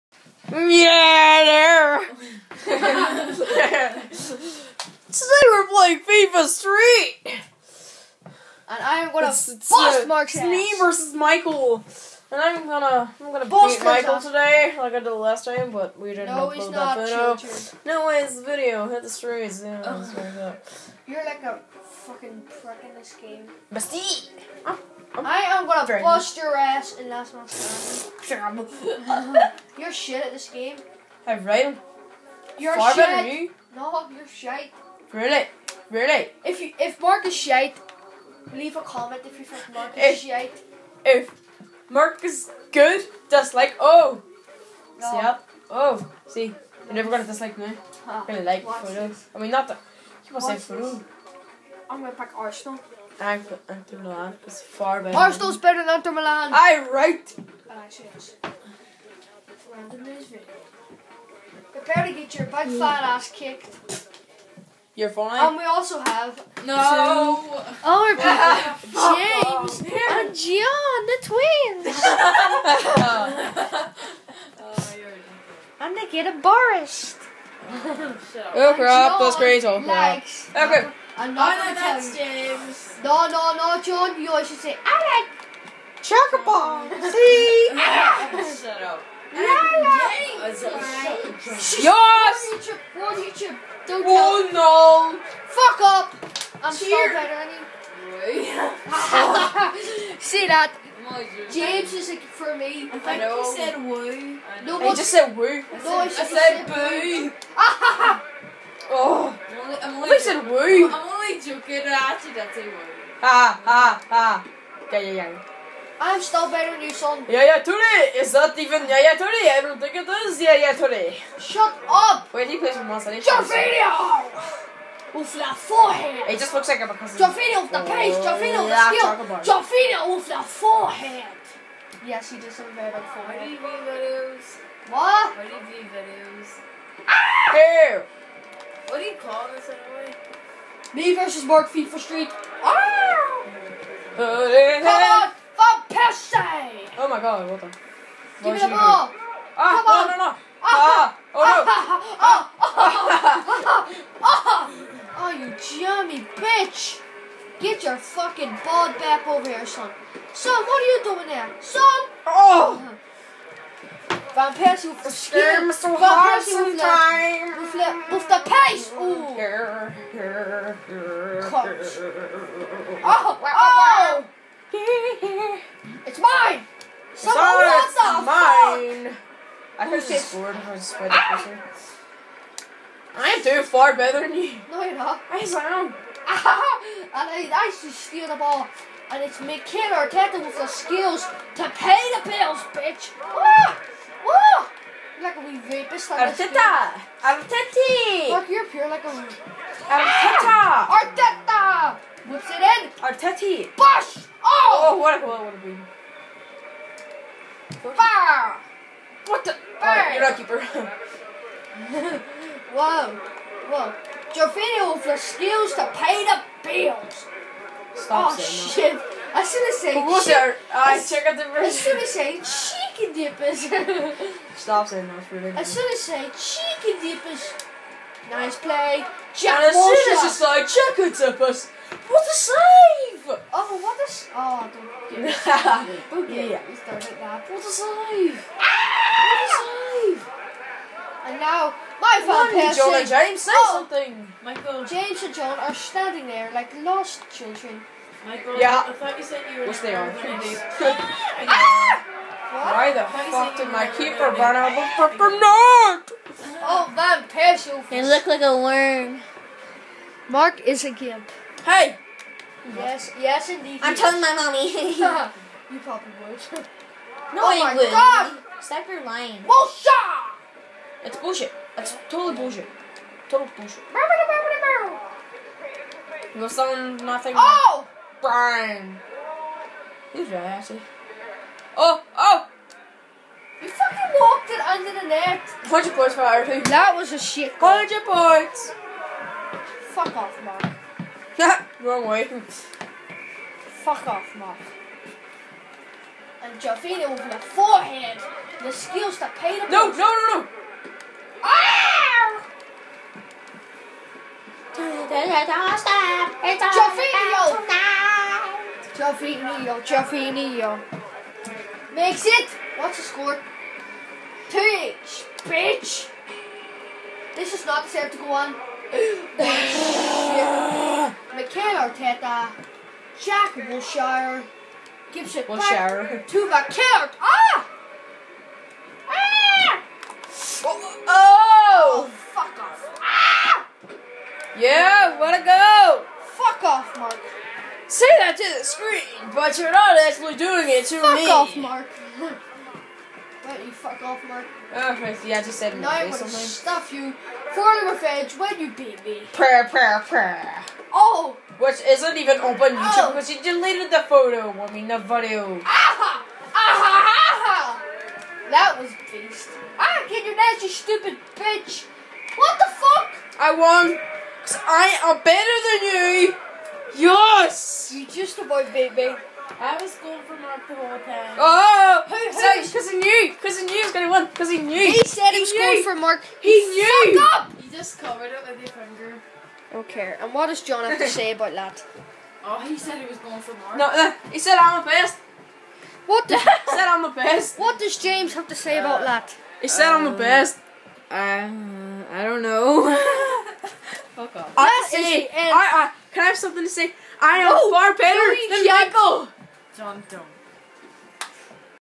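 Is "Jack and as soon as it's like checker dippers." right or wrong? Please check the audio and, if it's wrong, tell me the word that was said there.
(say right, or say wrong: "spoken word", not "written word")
right.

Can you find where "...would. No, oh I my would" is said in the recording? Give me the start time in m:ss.
4:26.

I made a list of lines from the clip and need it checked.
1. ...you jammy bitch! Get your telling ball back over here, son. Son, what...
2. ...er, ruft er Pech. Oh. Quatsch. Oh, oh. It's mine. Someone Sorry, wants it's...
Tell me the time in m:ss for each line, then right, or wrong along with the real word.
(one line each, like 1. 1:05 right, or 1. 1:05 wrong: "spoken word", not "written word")
1. 2:35 wrong: "fucking", not "telling"
2. 2:46 right.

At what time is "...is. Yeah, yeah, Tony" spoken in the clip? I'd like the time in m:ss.
2:00.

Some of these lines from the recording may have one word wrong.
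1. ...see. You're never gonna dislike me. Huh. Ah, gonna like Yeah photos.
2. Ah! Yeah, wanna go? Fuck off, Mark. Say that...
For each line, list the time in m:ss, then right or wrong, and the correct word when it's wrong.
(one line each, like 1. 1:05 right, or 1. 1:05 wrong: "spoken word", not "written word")
1. 0:46 wrong: "Watch", not "Yeah"
2. 5:33 right.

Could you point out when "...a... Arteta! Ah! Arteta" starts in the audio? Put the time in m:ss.
3:19.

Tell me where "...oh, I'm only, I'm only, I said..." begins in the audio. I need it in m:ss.
1:48.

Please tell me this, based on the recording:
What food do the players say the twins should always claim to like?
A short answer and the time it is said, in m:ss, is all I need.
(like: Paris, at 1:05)
Chocobon, at 1:24.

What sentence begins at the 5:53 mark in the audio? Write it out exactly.
because you deleted the photo, I mean the video.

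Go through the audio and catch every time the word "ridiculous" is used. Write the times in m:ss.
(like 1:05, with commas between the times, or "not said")
3:45.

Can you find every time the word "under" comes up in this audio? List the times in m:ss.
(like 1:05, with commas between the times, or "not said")
4:44.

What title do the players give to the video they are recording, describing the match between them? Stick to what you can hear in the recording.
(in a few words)
Me versus Mark FIFA Street.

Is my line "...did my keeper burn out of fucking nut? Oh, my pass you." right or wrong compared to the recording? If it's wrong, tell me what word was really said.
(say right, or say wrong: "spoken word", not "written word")
right.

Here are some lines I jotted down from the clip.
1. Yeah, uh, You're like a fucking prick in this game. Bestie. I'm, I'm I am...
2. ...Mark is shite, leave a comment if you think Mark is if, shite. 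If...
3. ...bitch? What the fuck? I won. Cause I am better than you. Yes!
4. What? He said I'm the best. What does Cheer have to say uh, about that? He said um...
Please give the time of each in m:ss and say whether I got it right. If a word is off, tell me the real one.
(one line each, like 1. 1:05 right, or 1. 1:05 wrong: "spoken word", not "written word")
1. 0:19 right
2. 0:37 right
3. 6:01 right
4. 6:26 wrong: "James", not "Cheer".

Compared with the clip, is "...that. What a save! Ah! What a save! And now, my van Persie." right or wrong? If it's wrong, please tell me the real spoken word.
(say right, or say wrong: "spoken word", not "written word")
right.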